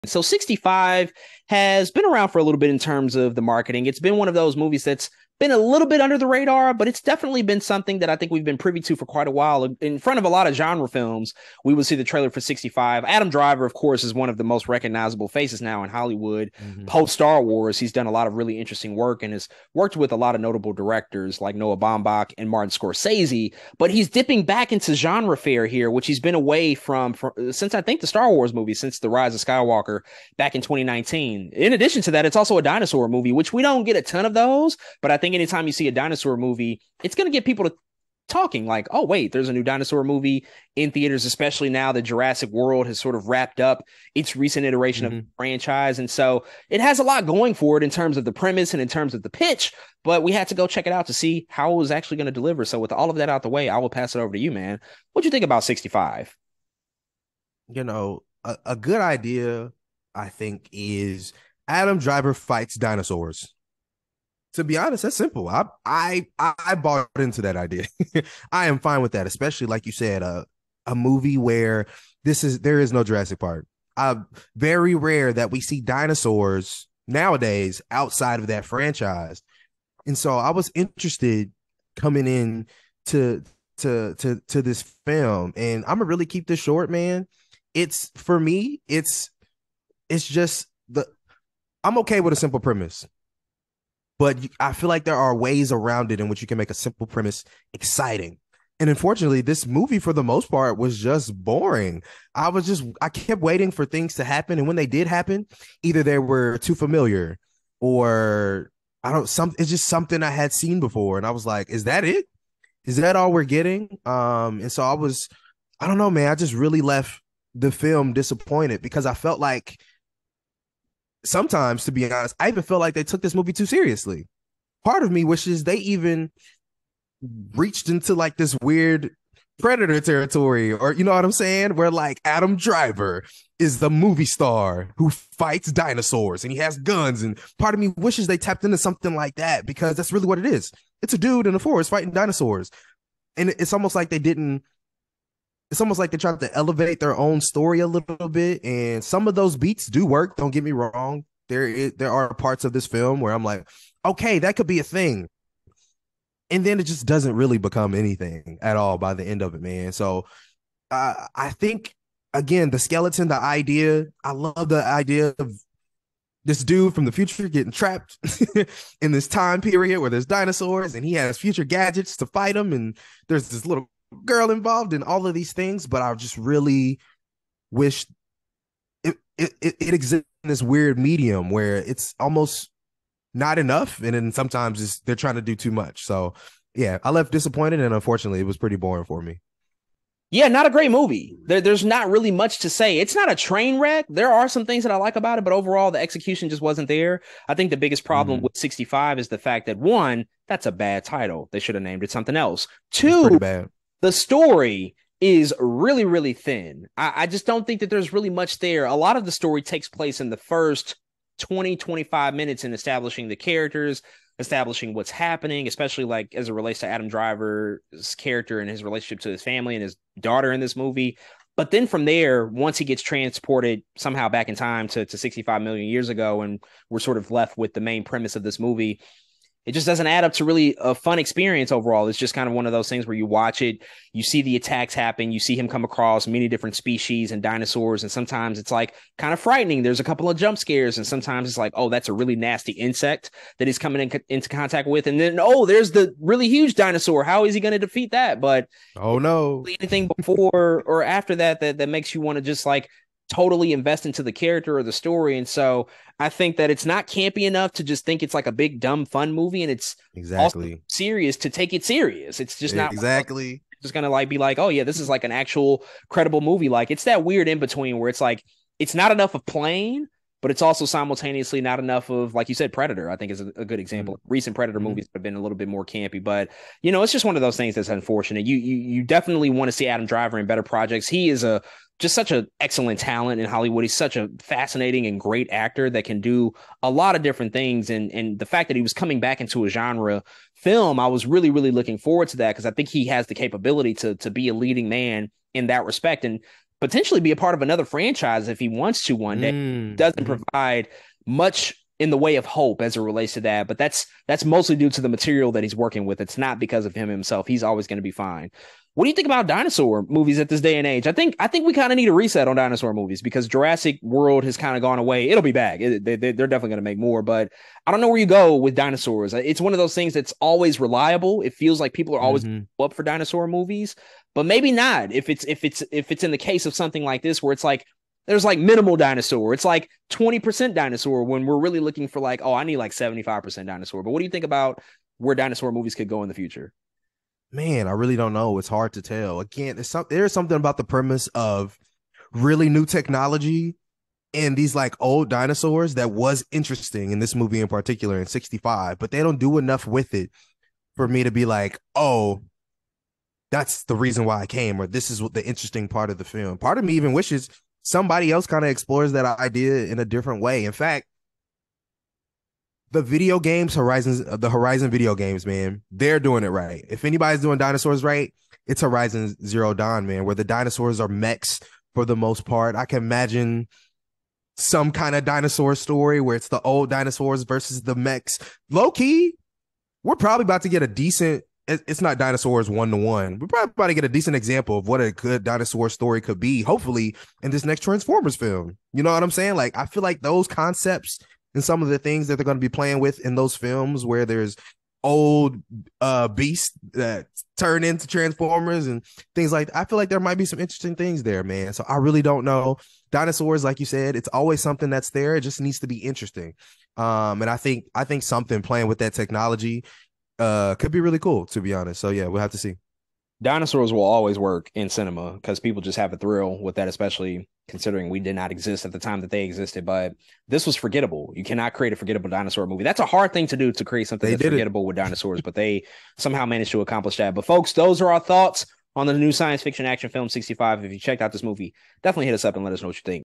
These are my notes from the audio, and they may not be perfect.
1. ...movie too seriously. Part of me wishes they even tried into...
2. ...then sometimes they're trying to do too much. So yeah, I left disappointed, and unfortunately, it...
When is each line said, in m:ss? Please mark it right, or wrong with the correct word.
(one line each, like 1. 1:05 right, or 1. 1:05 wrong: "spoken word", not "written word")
1. 2:03 wrong: "reached", not "tried"
2. 3:04 right.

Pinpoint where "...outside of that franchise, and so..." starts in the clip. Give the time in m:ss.
1:17.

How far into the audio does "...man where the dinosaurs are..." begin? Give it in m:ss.
6:10.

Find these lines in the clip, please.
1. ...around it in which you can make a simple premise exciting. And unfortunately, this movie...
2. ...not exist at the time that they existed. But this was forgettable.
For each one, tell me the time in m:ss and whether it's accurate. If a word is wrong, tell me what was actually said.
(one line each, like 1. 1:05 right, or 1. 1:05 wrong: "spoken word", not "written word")
1. 1:35 right
2. 6:58 right.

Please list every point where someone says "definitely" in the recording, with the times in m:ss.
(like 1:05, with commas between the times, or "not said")
0:07, 4:39, 5:16, 7:12.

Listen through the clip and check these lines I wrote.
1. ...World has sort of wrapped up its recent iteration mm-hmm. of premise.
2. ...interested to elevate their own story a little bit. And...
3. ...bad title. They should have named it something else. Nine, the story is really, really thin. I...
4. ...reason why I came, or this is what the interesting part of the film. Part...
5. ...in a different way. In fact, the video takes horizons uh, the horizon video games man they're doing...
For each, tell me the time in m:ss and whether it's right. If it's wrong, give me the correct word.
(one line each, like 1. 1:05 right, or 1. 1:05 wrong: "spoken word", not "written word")
1. 0:42 wrong: "franchise", not "premise"
2. 2:26 wrong: "tried", not "interested"
3. 3:20 wrong: "Two", not "Nine"
4. 5:53 right
5. 5:59 wrong: "games", not "takes".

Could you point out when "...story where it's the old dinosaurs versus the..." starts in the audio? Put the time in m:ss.
6:15.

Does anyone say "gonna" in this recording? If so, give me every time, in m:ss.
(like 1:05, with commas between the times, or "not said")
1:25, 4:23.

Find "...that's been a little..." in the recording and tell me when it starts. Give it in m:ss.
0:04.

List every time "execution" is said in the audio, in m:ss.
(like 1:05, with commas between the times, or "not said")
3:15.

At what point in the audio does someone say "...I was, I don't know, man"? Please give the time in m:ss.
1:54.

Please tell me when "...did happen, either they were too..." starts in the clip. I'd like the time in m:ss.
1:44.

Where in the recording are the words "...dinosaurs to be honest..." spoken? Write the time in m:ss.
1:02.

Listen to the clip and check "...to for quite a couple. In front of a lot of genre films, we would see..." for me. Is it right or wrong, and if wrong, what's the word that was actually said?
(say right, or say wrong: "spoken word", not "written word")
wrong: "while", not "couple".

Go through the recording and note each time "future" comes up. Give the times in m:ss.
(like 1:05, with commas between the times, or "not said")
2:47, 2:51, 5:36.